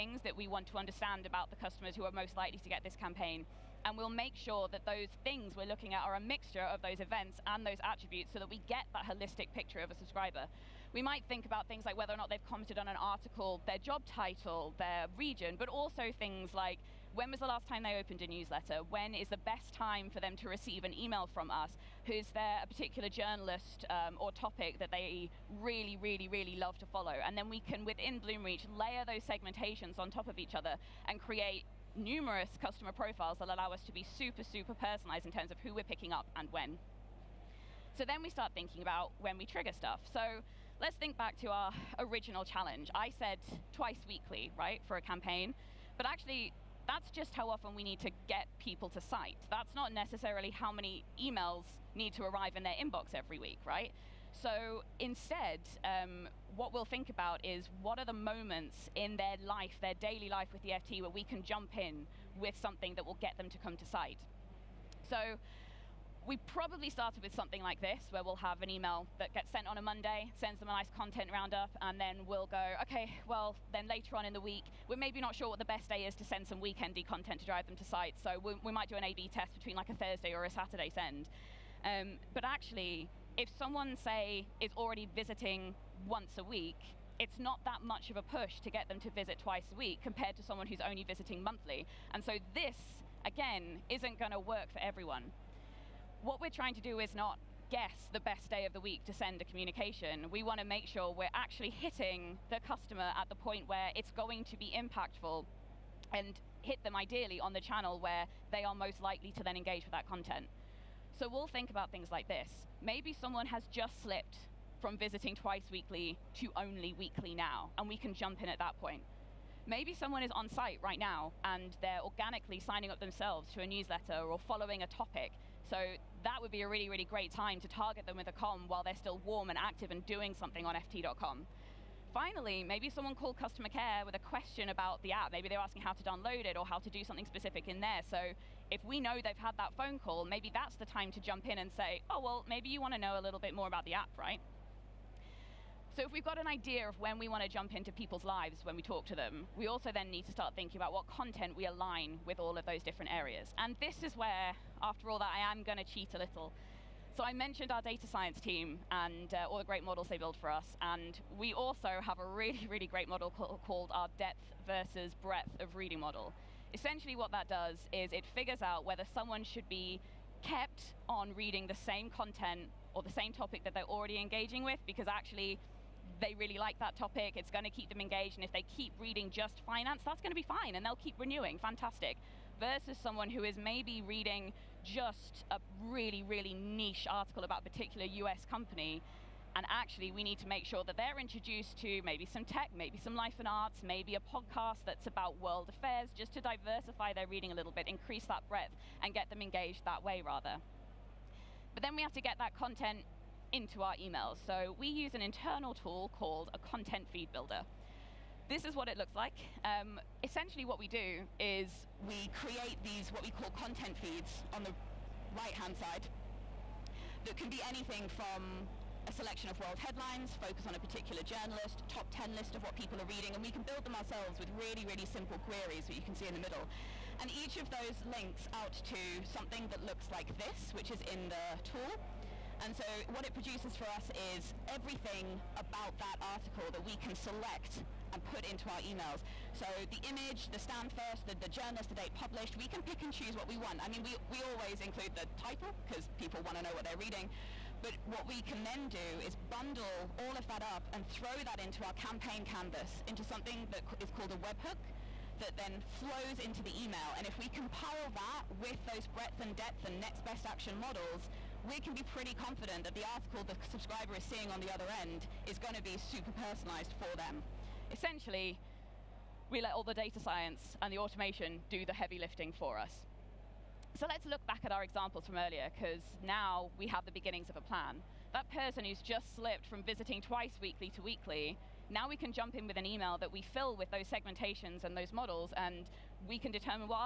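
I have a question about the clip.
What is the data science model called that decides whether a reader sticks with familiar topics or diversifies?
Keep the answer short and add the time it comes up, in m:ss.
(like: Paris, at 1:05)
Depth versus breadth of reading, at 2:44.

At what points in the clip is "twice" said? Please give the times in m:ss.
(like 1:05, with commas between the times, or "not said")
0:43, 1:29, 1:55, 4:40.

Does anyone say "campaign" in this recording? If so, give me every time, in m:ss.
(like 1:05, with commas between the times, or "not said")
0:02, 0:45, 4:11.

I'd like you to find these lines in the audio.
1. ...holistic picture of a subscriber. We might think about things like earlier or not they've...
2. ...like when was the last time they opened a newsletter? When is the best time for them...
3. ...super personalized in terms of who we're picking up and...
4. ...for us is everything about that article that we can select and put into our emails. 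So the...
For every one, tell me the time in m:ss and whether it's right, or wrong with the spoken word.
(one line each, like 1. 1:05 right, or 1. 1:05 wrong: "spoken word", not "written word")
1. 0:09 wrong: "whether", not "earlier"
2. 0:16 right
3. 0:34 right
4. 3:53 right.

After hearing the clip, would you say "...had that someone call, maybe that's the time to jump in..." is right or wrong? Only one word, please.
wrong.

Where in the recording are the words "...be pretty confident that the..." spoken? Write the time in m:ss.
4:21.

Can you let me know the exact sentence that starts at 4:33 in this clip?
So let's look back at our examples from earlier, because now we have the beginnings of a plan.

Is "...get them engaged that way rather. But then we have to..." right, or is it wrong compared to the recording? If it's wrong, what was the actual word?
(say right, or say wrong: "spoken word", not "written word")
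right.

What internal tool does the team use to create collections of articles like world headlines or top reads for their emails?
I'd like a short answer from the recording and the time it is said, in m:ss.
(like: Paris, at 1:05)
Content feed builder, at 3:26.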